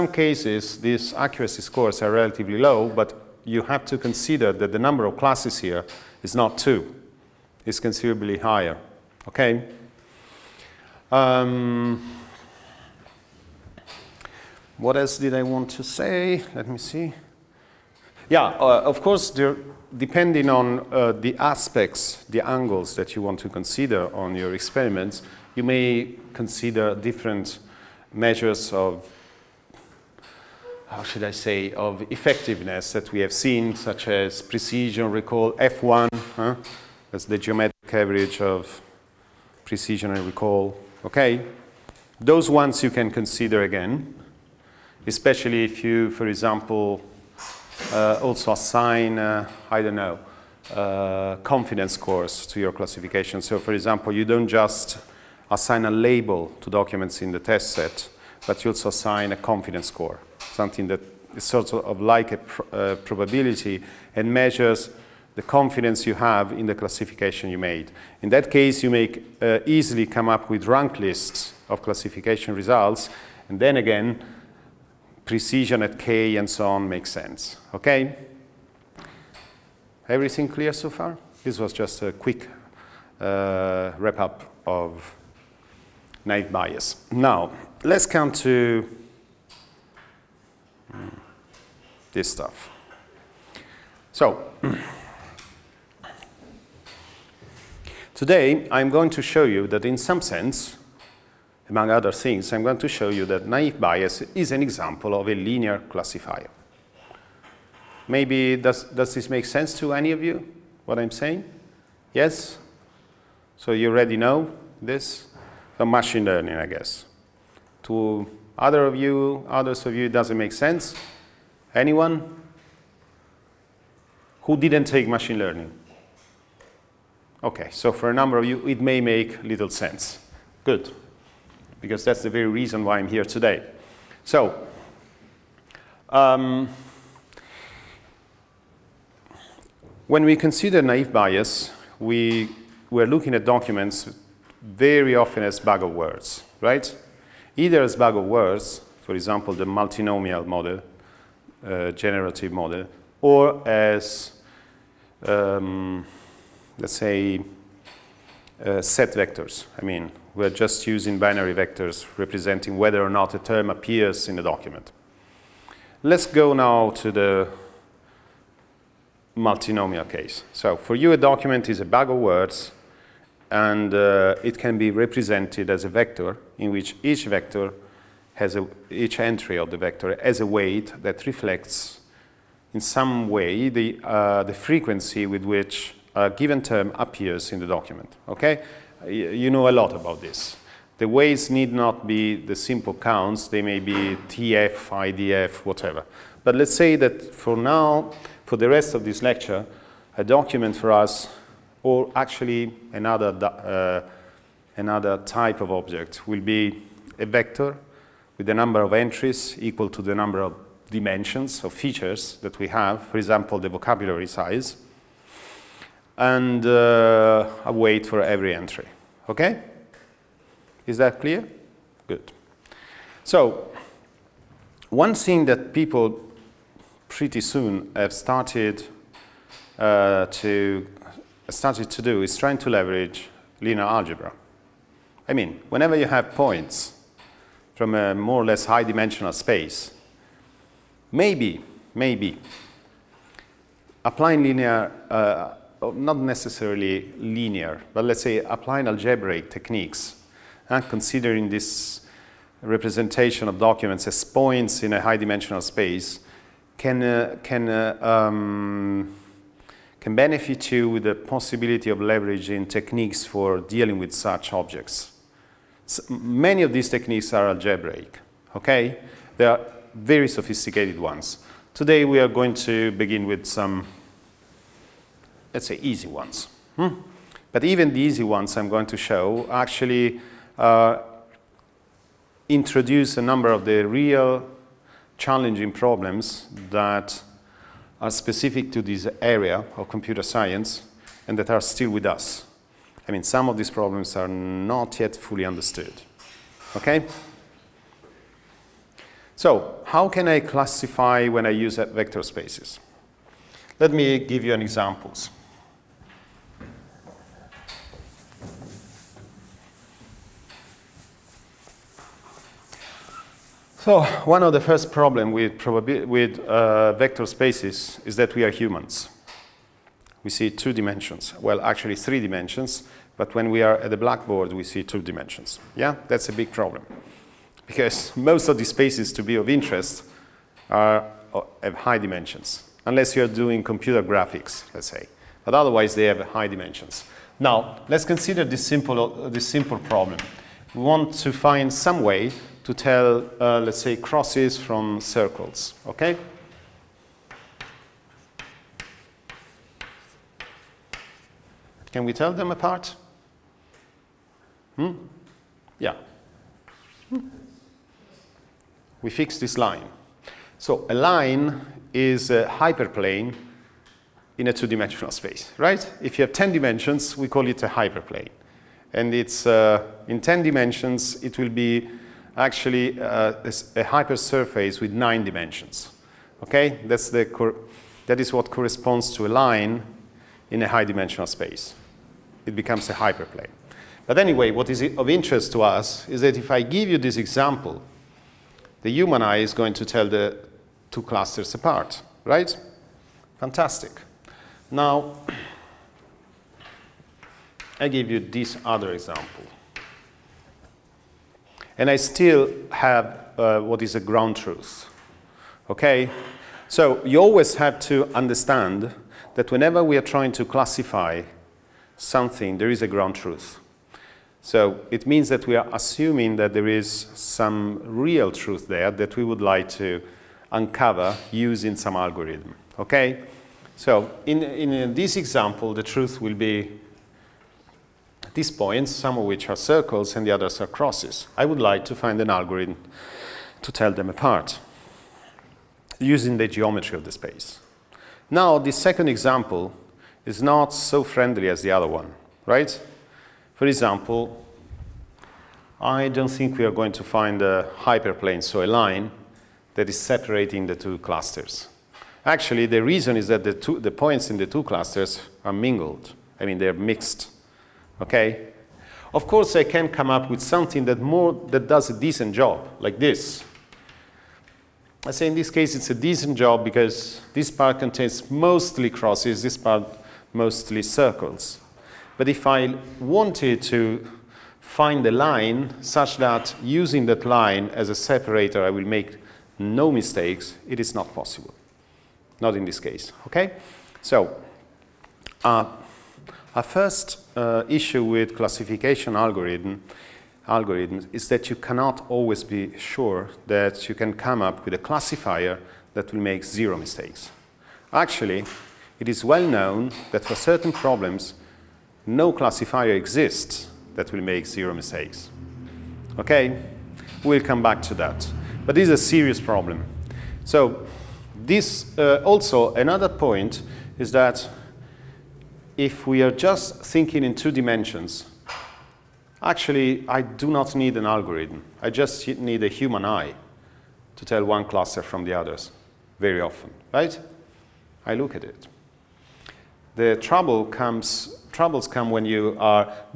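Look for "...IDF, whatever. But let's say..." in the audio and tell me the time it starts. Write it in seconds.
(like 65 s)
194 s.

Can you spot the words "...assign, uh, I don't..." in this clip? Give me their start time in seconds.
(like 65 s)
48 s.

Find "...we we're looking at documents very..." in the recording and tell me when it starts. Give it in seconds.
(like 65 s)
141 s.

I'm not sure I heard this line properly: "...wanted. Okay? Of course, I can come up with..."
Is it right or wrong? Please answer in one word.
wrong.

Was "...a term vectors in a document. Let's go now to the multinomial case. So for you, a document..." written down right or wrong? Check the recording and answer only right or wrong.
wrong.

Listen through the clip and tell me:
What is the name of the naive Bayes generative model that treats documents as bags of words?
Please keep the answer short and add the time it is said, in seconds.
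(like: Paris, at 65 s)
multinomial model, at 149 s.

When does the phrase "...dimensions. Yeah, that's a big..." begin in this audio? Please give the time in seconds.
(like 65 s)
325 s.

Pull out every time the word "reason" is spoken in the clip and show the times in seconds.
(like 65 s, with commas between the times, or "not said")
132 s, 452 s.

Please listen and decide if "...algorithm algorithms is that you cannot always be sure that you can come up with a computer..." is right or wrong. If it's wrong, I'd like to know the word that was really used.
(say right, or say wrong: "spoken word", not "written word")
wrong: "classifier", not "computer".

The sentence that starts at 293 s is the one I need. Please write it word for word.
I mean, some of these problems are not yet fully understood.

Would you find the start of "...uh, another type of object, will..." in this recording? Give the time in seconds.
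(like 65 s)
203 s.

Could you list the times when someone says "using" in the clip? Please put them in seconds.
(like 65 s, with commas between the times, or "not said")
160 s, 421 s, 435 s, 476 s.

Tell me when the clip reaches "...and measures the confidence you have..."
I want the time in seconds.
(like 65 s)
64 s.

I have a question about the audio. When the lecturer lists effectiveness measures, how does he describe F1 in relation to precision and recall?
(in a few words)
geometric average.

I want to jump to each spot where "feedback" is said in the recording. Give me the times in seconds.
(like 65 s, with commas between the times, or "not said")
not said.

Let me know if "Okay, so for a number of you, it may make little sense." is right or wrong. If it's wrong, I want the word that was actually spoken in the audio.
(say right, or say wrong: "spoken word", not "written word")
right.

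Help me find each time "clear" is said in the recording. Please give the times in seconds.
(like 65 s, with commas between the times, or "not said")
80 s, 221 s.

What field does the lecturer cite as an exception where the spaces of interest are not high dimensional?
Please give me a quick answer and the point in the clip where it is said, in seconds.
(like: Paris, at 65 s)
computer graphics, at 333 s.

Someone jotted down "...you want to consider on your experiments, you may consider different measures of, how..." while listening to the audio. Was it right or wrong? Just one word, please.
right.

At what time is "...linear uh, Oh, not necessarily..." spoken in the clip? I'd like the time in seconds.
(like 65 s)
244 s.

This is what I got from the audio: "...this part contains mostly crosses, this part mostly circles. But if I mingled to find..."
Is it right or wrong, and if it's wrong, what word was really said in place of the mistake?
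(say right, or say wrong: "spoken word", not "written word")
wrong: "wanted", not "mingled".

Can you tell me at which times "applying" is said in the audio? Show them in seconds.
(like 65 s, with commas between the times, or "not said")
244 s, 248 s.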